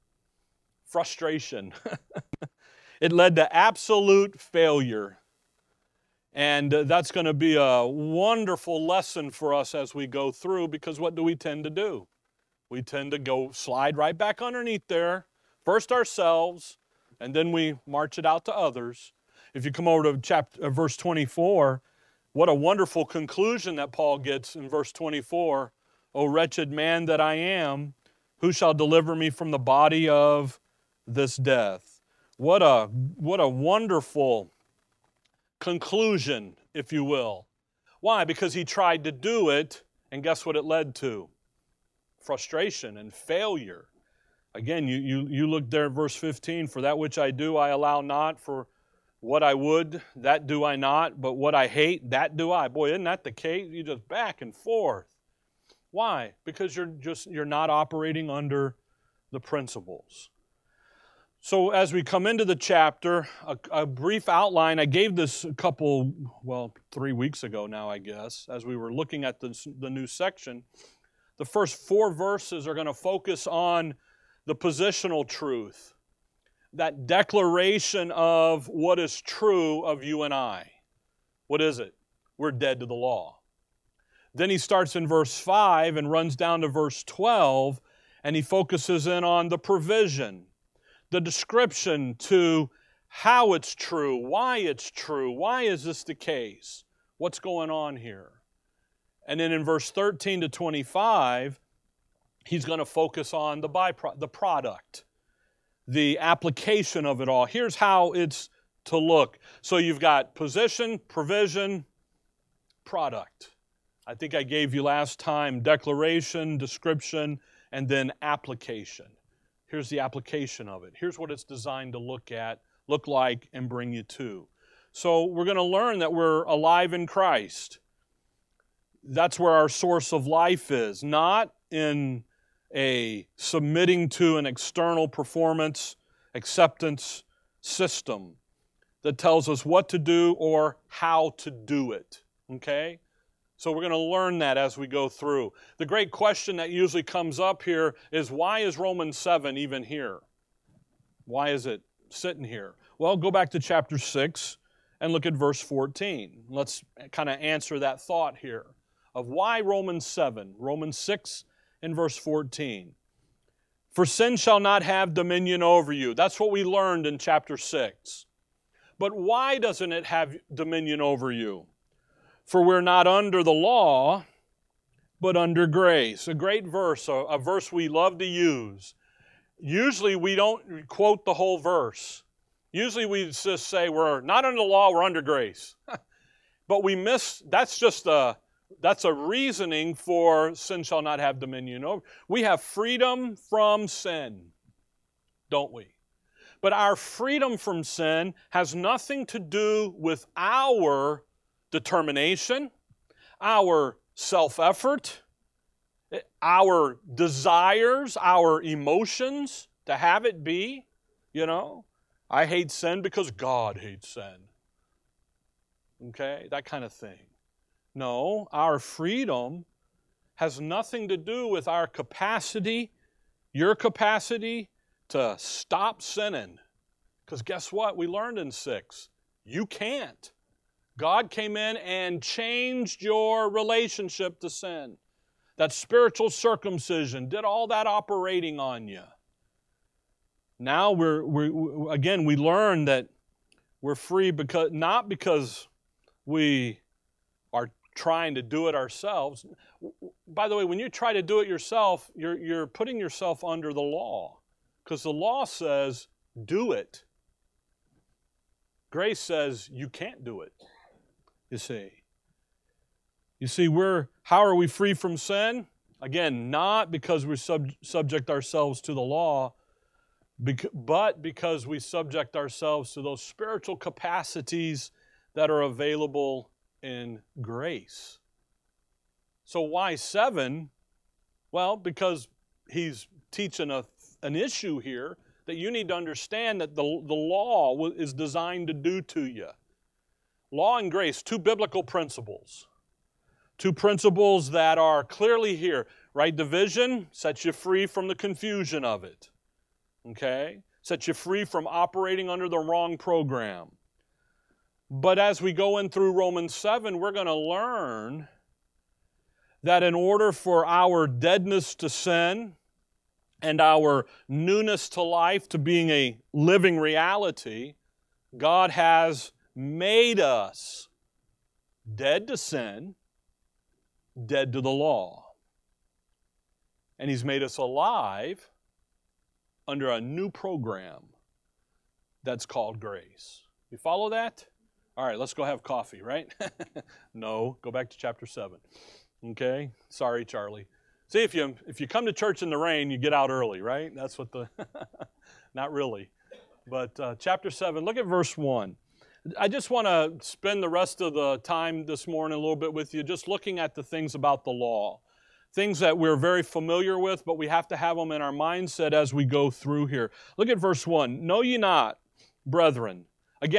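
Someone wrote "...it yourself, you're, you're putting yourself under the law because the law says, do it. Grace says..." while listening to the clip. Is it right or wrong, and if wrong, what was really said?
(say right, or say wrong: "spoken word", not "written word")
right.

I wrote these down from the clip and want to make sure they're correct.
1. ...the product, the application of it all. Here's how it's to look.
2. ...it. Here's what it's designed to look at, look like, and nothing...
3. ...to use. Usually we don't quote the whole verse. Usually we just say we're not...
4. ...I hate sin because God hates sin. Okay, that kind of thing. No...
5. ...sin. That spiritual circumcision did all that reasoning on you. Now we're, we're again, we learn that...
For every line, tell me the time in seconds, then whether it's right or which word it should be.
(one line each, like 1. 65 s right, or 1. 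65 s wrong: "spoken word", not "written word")
1. 104 s right
2. 120 s wrong: "bring", not "nothing"
3. 178 s right
4. 212 s right
5. 234 s wrong: "operating", not "reasoning".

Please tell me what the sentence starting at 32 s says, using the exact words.
What a, what a wonderful conclusion, if you will.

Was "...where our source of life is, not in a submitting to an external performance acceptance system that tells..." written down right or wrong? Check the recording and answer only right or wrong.
right.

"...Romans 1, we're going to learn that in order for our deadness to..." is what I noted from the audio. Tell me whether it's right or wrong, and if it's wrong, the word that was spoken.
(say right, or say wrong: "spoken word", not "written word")
wrong: "7", not "1".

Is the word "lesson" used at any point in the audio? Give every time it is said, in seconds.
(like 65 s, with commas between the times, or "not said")
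8 s.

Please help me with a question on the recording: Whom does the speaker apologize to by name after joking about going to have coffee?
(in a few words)
Charlie.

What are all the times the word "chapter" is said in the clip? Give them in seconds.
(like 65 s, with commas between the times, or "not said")
20 s, 62 s, 153 s, 167 s, 337 s, 347 s.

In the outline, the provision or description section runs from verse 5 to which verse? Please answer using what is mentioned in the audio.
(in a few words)
12.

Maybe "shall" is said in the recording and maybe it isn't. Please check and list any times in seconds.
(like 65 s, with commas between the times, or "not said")
28 s, 164 s, 190 s.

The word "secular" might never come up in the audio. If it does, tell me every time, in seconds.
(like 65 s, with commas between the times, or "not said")
not said.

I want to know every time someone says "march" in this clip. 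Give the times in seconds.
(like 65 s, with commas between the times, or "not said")
17 s.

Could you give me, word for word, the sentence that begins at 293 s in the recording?
Two principles that are clearly here, right?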